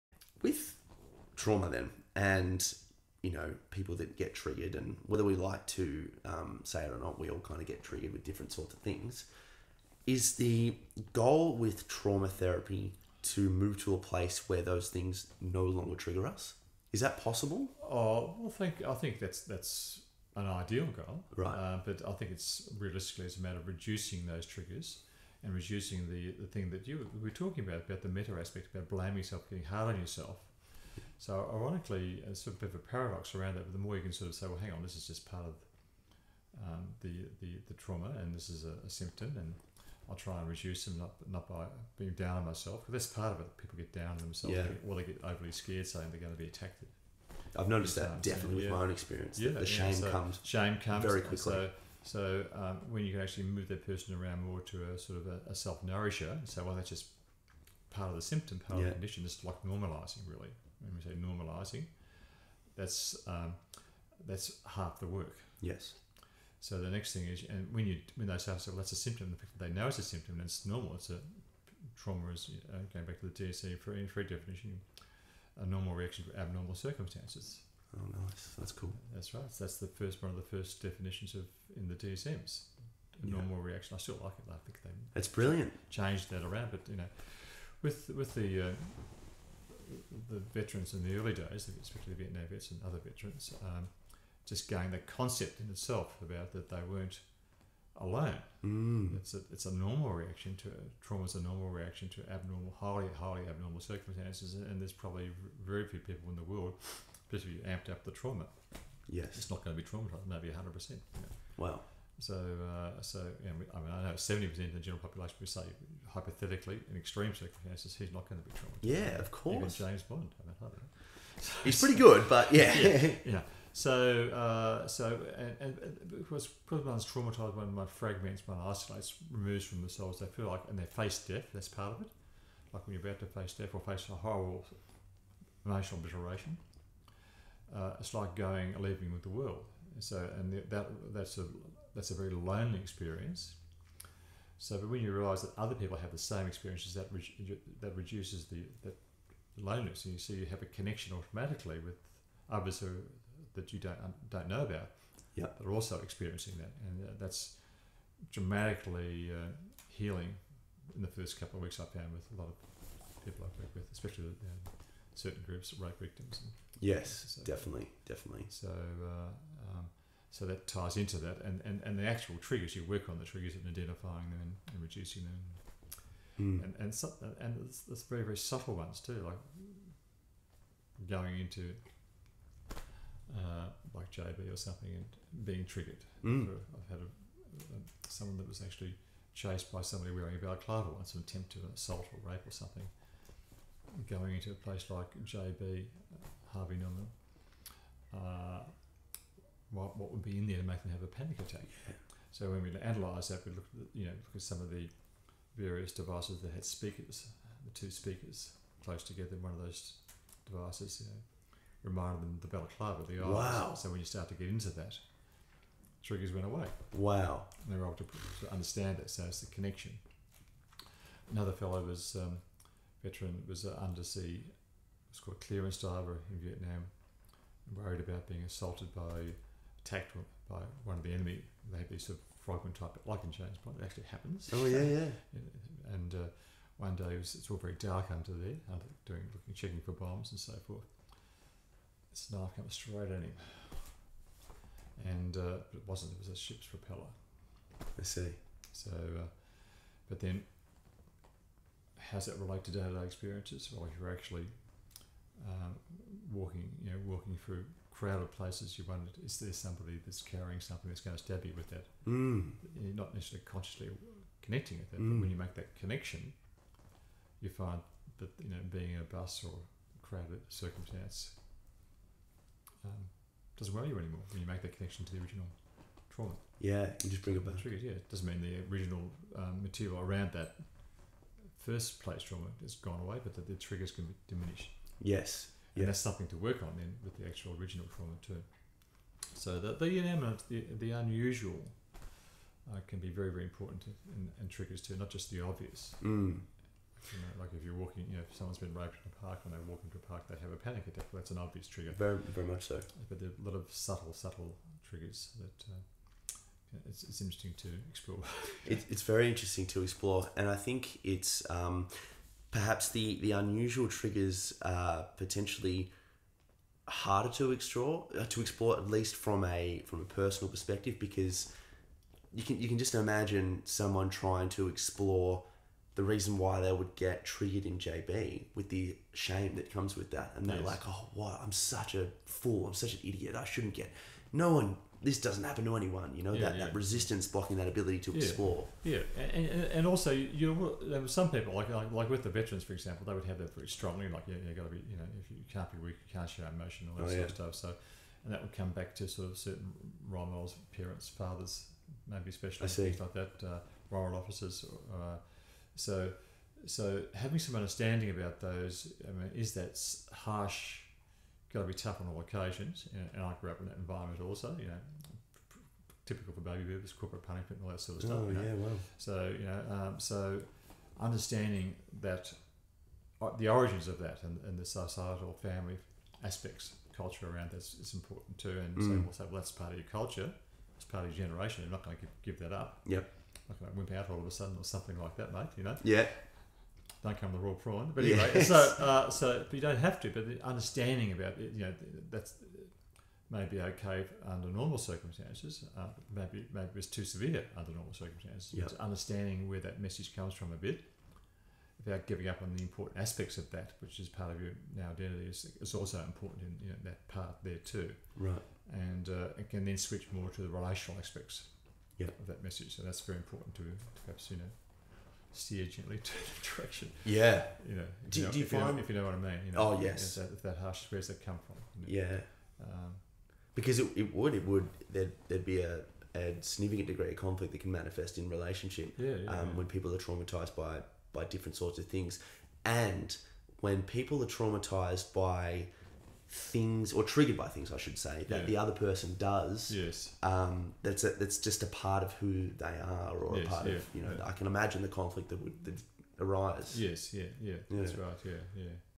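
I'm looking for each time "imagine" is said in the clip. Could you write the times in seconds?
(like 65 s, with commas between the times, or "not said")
322 s, 444 s.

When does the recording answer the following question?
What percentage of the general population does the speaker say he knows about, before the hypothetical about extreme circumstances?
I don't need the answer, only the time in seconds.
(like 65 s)
114 s.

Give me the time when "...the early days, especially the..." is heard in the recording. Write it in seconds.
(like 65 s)
91 s.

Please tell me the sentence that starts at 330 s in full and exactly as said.
like oh what I'm such a fool I'm such an idiot I shouldn't get no one this doesn't happen to anyone.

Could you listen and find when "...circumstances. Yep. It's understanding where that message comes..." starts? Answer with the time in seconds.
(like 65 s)
397 s.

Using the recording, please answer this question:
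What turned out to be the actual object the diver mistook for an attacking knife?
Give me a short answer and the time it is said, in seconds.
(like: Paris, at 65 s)
A ship's propeller, at 246 s.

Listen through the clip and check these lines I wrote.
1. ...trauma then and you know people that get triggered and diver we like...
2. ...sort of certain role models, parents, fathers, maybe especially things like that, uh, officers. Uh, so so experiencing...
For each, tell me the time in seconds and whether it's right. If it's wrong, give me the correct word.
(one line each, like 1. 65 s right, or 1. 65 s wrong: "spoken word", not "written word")
1. 1 s wrong: "whether", not "diver"
2. 349 s wrong: "having", not "experiencing".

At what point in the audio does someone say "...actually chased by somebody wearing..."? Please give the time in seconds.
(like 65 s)
188 s.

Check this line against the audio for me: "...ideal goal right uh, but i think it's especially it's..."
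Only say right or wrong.
wrong.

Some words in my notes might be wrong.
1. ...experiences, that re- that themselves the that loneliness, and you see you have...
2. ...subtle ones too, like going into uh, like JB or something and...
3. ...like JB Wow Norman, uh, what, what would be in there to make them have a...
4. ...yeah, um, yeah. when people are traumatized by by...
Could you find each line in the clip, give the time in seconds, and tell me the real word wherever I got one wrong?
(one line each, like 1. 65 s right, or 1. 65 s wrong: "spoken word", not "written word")
1. 146 s wrong: "reduces", not "themselves"
2. 178 s right
3. 194 s wrong: "Harvey", not "Wow"
4. 429 s right.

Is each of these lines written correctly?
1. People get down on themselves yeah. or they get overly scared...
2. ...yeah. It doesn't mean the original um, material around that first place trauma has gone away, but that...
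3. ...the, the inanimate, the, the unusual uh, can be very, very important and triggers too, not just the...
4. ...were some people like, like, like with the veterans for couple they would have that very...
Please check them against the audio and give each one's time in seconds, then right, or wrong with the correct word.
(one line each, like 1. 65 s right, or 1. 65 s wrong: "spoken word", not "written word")
1. 43 s right
2. 277 s right
3. 289 s right
4. 341 s wrong: "example", not "couple".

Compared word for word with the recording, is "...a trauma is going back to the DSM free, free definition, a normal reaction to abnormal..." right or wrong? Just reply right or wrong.
right.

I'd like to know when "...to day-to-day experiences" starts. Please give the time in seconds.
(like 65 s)
252 s.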